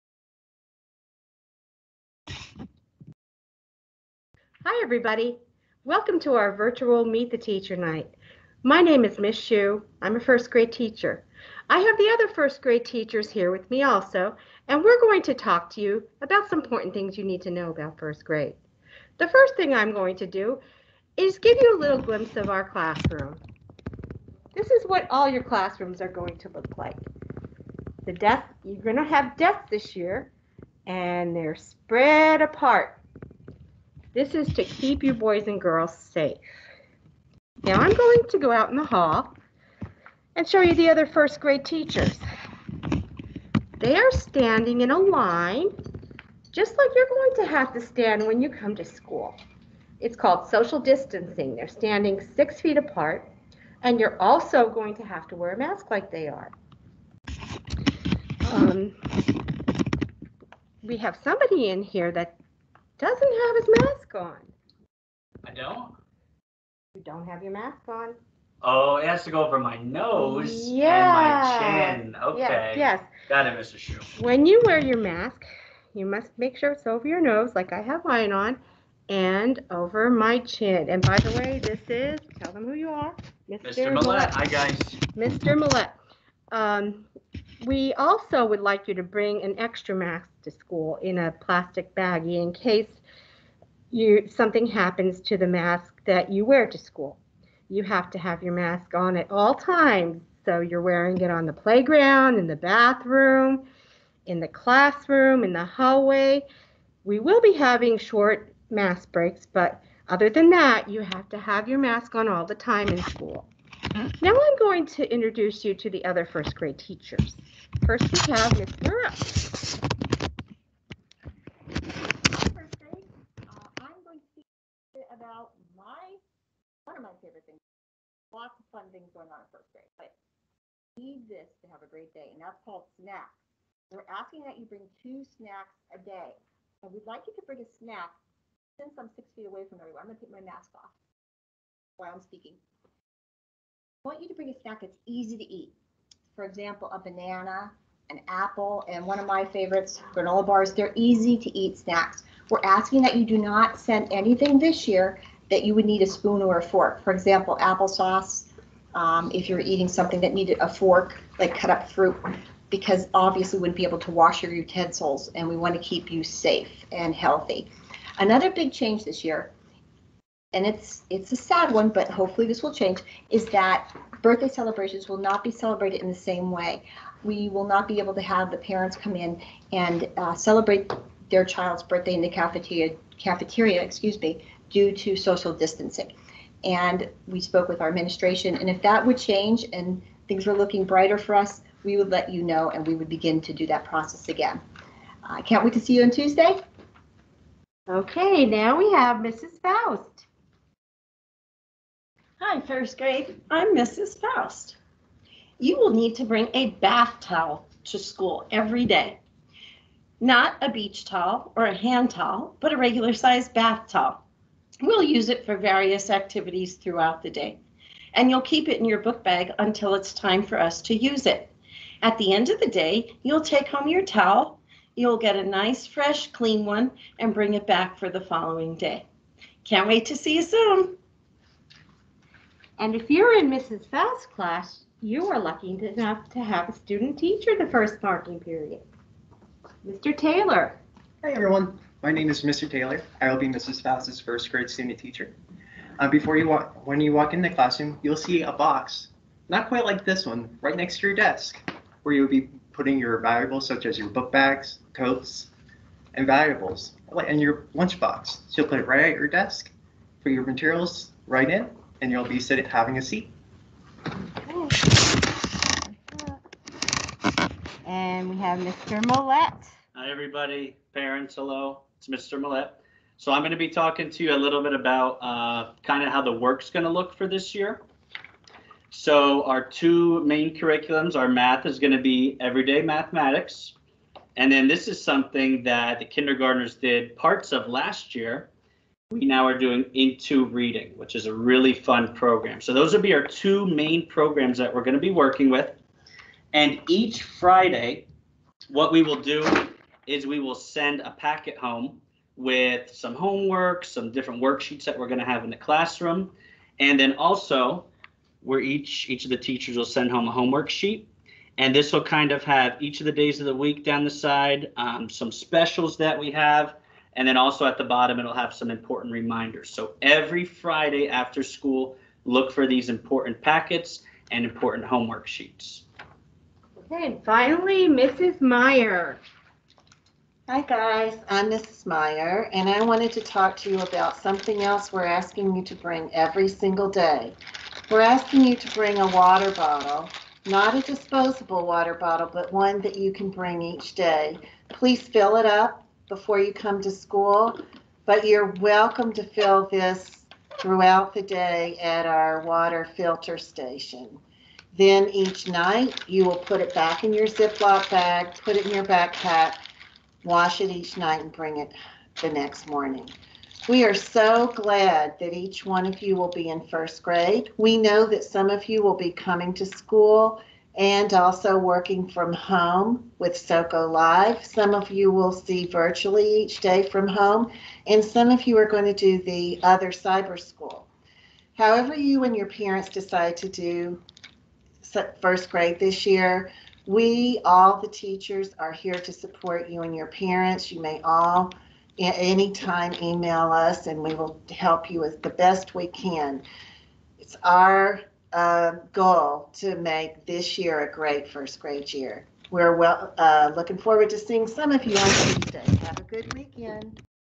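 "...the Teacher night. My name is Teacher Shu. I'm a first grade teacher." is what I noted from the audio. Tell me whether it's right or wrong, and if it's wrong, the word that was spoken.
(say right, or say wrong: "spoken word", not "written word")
wrong: "Miss", not "Teacher".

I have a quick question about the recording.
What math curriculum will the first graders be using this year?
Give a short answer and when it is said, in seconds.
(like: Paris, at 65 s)
Everyday Mathematics, at 282 s.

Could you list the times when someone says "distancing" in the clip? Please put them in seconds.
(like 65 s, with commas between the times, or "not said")
50 s, 185 s.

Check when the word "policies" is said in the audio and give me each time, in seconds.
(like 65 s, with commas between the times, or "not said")
not said.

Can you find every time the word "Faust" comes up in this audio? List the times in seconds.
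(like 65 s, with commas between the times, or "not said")
199 s, 204 s, 233 s, 243 s.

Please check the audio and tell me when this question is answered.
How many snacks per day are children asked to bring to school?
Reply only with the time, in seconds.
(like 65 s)
135 s.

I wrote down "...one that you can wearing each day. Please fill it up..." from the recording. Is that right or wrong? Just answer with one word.
wrong.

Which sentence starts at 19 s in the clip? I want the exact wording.
The first thing I'm going to do is give you a little glimpse of our classroom.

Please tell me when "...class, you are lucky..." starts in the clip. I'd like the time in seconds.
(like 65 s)
234 s.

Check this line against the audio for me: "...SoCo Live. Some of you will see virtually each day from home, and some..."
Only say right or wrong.
right.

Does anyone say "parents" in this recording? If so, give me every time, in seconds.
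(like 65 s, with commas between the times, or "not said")
178 s, 270 s, 382 s, 390 s.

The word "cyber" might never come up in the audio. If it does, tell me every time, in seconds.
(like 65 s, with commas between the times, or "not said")
379 s.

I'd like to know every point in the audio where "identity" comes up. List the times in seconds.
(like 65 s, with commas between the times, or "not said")
not said.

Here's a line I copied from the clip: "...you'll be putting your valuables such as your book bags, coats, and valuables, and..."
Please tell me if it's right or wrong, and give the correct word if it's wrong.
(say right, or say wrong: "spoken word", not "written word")
right.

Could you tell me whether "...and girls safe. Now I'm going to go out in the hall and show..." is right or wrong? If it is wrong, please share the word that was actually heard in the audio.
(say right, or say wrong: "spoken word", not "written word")
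right.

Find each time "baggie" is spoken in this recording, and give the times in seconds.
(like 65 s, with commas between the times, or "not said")
91 s.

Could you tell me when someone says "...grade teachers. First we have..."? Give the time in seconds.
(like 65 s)
116 s.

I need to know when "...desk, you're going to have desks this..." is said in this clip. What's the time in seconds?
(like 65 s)
28 s.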